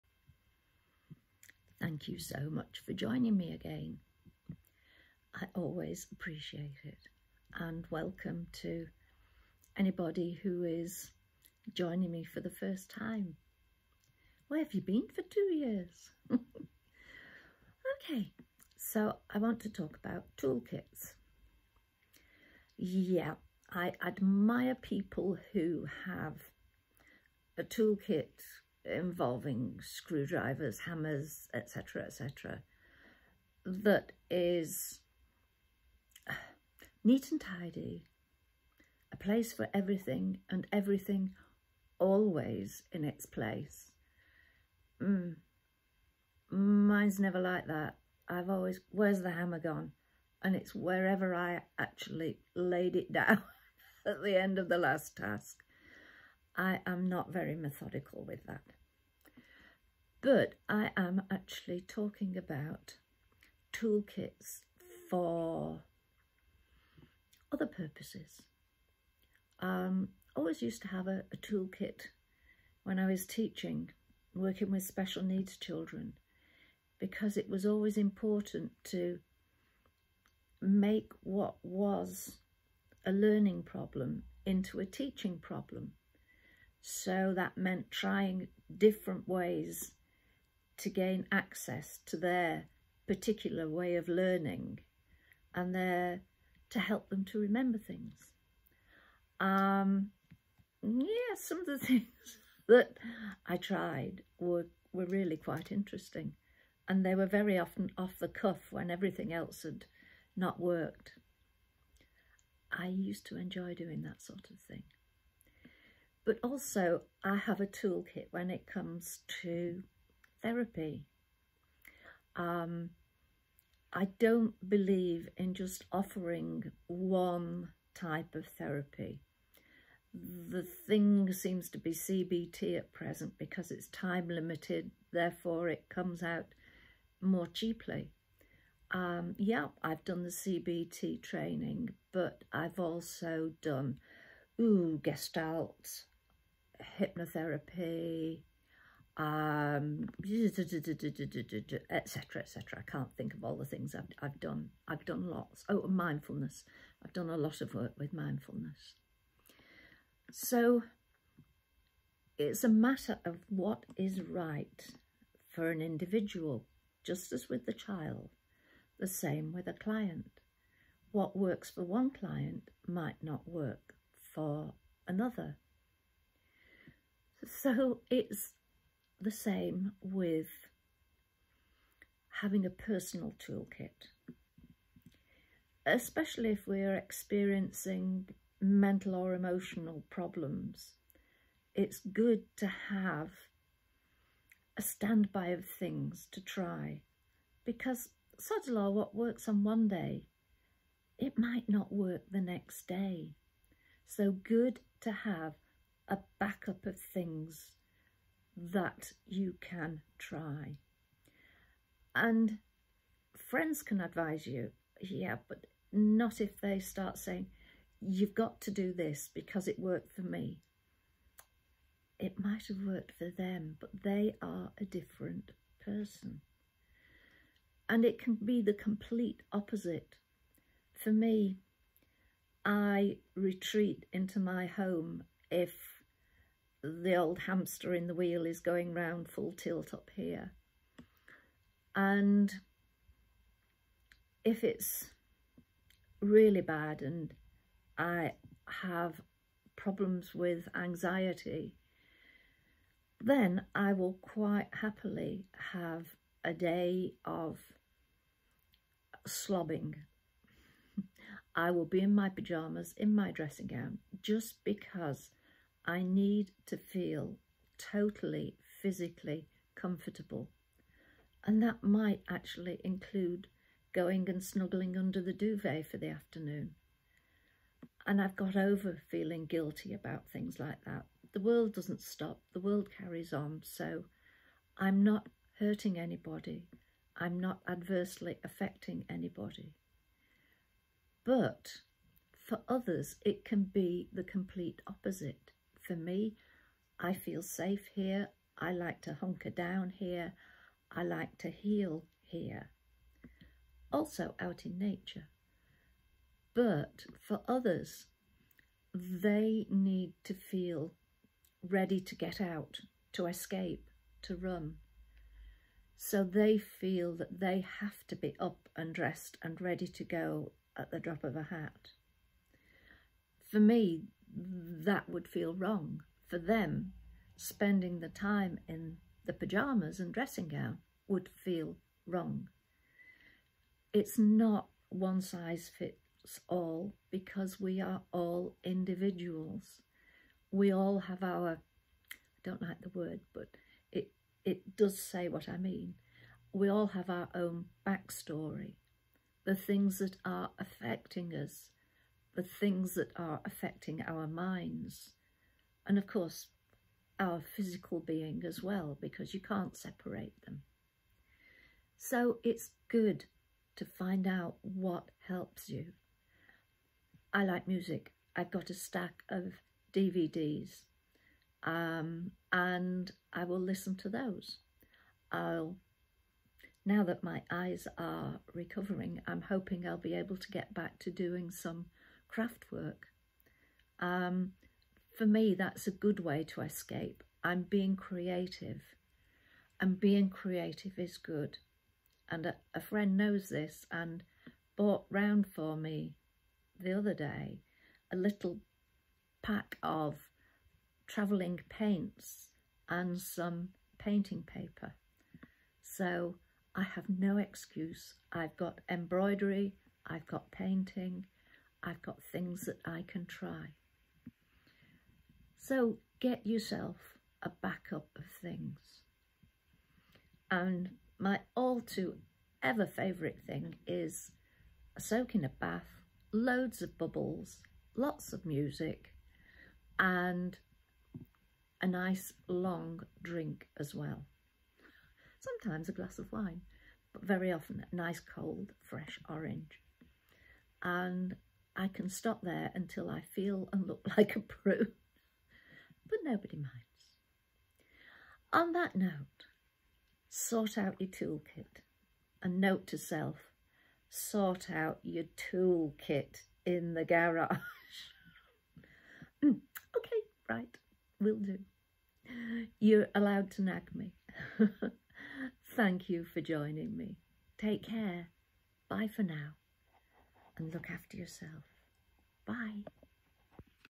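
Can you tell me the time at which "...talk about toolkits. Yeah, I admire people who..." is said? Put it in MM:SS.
00:19.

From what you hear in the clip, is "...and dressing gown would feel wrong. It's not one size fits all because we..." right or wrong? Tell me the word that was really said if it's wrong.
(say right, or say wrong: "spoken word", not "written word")
right.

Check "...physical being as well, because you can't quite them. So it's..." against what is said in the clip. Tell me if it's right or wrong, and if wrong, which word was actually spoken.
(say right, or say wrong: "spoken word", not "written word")
wrong: "separate", not "quite".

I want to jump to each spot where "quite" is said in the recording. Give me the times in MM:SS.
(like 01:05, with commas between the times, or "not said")
01:45, 04:14.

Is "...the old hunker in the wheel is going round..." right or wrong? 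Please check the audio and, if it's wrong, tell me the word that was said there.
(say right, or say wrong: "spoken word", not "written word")
wrong: "hamster", not "hunker".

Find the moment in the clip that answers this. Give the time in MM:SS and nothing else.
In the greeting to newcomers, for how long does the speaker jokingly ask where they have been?
00:15.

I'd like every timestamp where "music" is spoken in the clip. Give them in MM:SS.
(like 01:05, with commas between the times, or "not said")
06:07, 07:08.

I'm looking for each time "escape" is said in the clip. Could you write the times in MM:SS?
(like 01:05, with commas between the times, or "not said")
05:13, 06:26.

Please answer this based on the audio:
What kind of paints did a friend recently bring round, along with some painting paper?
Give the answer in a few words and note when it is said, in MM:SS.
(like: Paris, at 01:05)
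travelling paints, at 06:41.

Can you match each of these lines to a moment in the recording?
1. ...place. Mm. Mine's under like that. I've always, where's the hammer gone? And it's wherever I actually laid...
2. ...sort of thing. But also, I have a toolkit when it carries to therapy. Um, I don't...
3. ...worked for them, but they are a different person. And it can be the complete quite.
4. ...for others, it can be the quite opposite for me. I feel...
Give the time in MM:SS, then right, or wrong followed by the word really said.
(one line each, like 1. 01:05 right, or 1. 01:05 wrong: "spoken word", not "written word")
1. 00:43 wrong: "never", not "under"
2. 01:54 wrong: "comes", not "carries"
3. 03:42 wrong: "opposite", not "quite"
4. 04:52 wrong: "complete", not "quite".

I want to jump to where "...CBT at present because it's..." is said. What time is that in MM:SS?
02:11.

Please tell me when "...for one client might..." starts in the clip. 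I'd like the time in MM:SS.
02:51.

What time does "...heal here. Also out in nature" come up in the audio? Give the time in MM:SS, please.
05:01.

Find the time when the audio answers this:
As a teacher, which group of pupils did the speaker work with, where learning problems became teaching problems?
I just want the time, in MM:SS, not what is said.
01:14.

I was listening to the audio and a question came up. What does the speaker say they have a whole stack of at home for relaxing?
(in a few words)
DVDs.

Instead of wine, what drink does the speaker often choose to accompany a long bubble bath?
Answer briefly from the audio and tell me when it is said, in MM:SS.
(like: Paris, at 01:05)
cold fresh orange, at 07:18.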